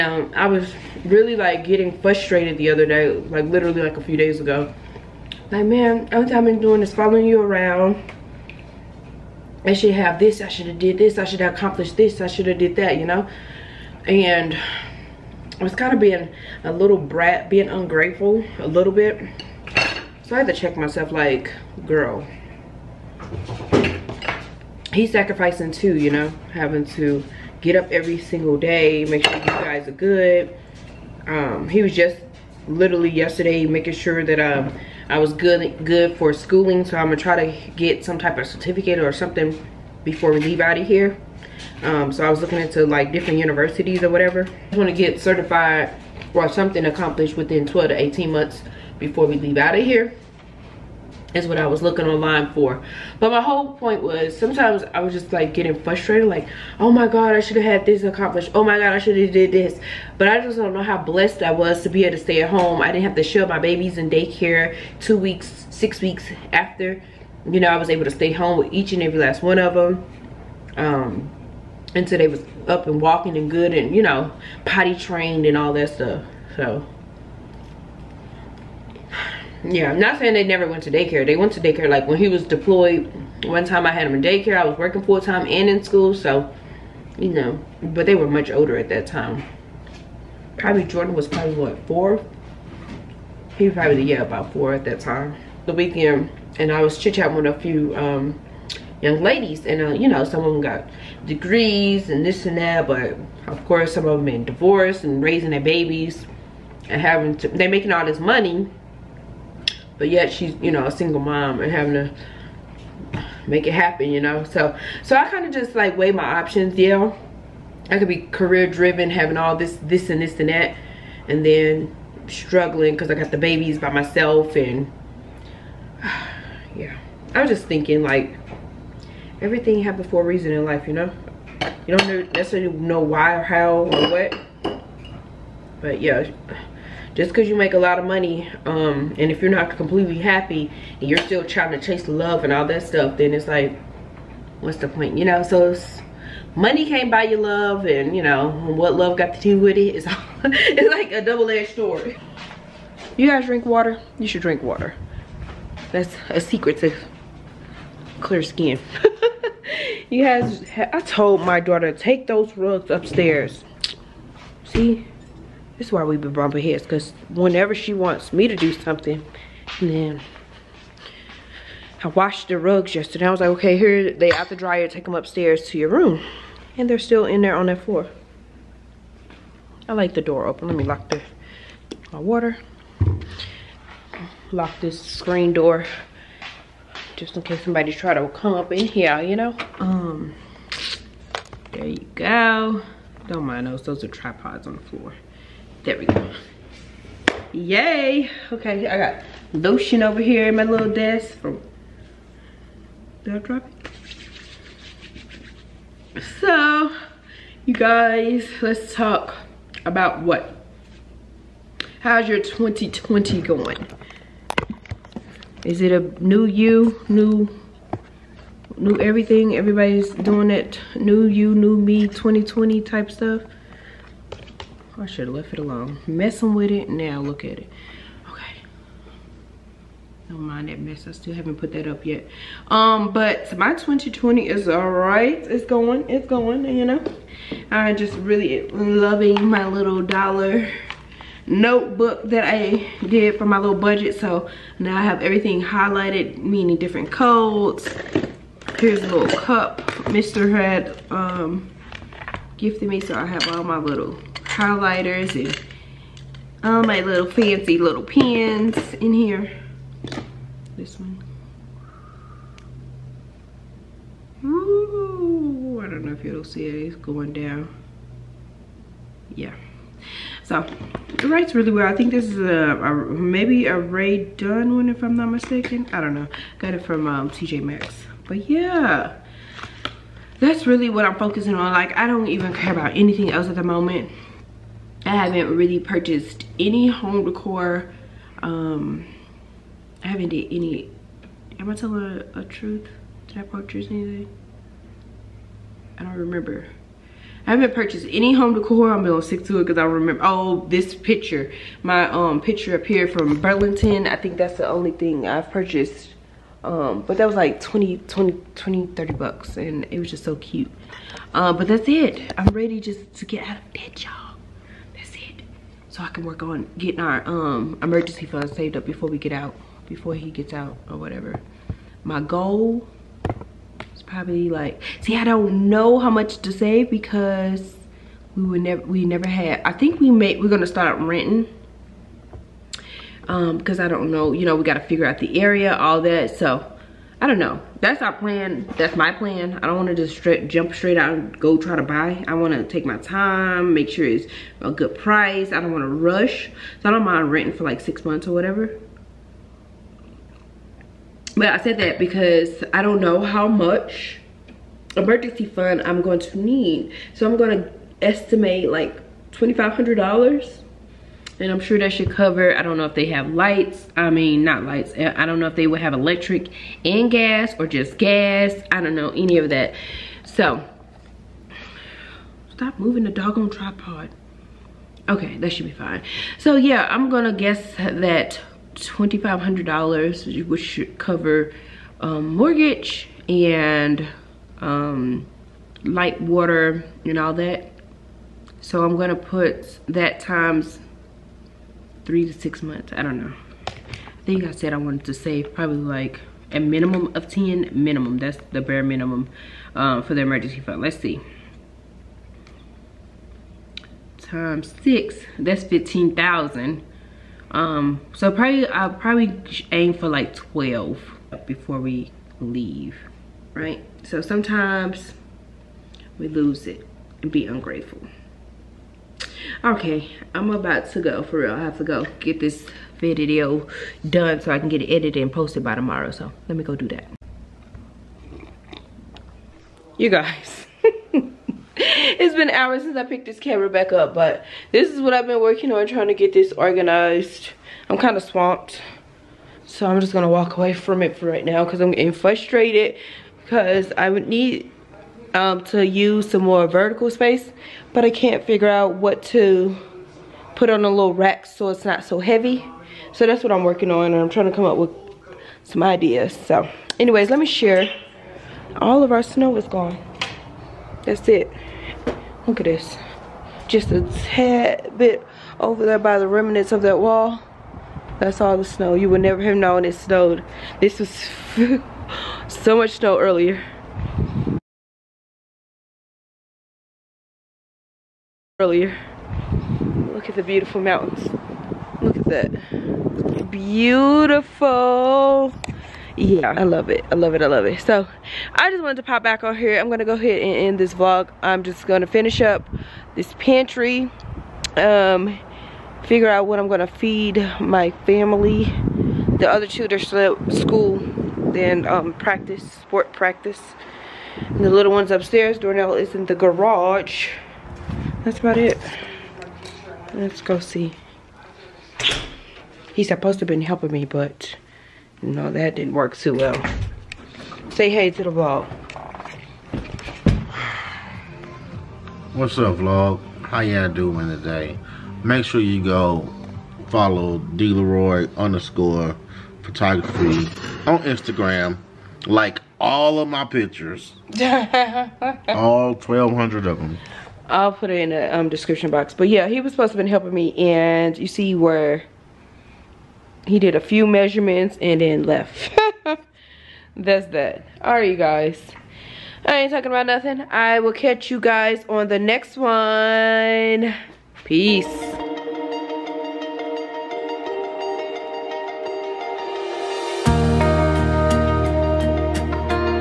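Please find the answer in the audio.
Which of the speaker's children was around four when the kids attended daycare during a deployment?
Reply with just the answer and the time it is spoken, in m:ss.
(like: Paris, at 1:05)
Jordan, at 1:30.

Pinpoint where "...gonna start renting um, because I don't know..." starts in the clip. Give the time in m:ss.
5:30.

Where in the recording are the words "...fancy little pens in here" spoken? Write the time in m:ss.
4:17.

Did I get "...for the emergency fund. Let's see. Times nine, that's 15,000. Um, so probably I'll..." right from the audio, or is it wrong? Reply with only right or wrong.
wrong.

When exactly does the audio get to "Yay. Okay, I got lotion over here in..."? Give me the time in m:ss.
3:17.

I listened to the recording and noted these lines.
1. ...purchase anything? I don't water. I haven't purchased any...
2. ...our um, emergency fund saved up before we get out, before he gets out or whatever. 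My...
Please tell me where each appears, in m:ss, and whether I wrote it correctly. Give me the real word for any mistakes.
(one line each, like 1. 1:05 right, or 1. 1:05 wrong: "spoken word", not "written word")
1. 4:53 wrong: "remember", not "water"
2. 5:17 right.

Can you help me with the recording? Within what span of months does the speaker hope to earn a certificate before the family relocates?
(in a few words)
12 to 18 months.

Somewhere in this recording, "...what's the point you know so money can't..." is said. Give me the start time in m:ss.
2:24.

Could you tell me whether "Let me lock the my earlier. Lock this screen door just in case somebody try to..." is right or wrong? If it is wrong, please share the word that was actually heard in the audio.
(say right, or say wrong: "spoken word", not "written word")
wrong: "water", not "earlier".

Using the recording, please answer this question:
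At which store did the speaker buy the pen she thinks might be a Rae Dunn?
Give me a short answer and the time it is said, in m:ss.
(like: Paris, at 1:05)
TJ Maxx, at 4:37.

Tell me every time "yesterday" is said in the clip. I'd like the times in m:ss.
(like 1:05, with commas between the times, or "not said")
0:33, 2:52.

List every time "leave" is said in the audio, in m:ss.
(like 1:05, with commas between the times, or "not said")
0:40, 0:49, 6:52.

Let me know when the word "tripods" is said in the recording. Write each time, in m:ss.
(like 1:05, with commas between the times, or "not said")
3:14, 6:13.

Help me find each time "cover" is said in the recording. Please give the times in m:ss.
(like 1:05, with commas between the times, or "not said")
6:02, 6:20.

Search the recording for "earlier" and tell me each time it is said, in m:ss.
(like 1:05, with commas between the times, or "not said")
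7:53, 7:58.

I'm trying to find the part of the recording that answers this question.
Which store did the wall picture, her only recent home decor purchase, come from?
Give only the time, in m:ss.
5:03.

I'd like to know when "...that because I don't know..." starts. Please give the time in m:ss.
5:51.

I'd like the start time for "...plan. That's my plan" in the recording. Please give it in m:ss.
5:38.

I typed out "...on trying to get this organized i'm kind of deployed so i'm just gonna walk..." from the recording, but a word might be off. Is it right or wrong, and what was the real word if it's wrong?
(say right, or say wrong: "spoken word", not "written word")
wrong: "swamped", not "deployed".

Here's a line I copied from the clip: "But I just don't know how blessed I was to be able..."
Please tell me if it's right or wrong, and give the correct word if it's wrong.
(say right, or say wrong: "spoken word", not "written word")
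right.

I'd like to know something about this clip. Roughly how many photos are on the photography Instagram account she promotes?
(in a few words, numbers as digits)
1,200.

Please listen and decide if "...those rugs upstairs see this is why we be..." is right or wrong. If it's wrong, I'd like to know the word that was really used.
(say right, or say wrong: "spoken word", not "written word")
right.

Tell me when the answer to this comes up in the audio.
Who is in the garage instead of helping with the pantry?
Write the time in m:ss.
8:25.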